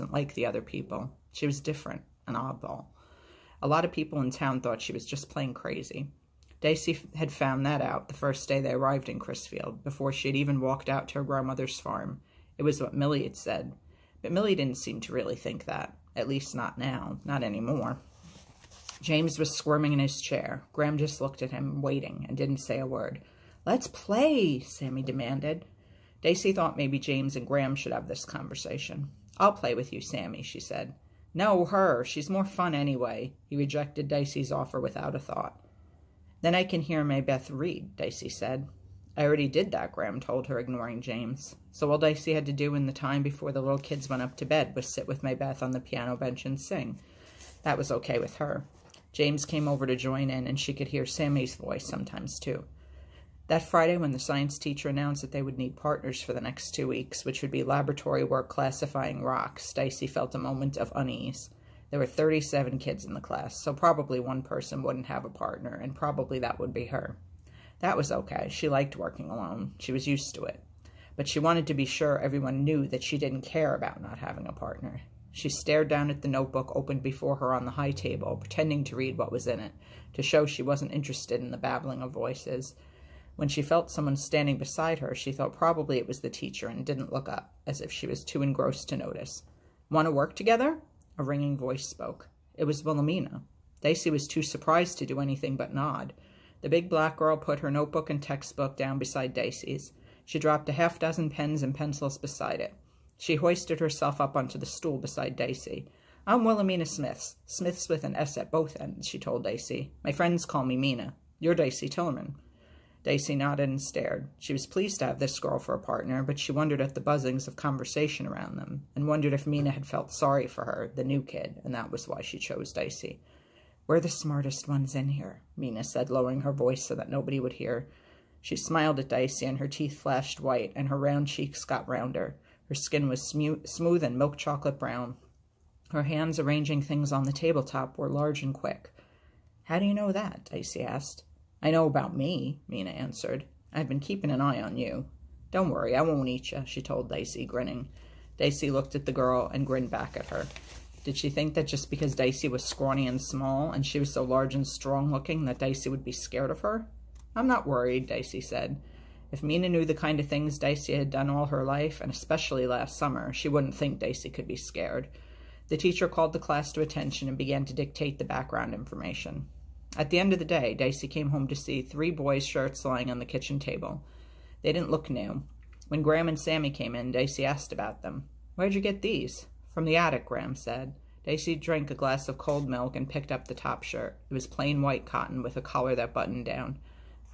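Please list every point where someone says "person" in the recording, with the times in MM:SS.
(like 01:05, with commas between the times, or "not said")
01:04.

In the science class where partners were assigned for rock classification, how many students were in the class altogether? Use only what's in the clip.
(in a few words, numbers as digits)
37.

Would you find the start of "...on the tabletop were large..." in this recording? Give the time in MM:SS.
02:17.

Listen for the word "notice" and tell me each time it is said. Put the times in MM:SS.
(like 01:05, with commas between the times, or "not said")
01:28.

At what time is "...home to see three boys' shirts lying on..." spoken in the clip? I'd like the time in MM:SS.
02:51.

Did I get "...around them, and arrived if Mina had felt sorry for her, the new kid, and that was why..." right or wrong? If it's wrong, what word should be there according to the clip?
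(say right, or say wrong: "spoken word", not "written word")
wrong: "wondered", not "arrived".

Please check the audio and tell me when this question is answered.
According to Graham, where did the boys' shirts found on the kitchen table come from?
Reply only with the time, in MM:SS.
02:59.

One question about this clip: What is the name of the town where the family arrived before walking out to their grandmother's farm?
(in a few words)
Crisfield.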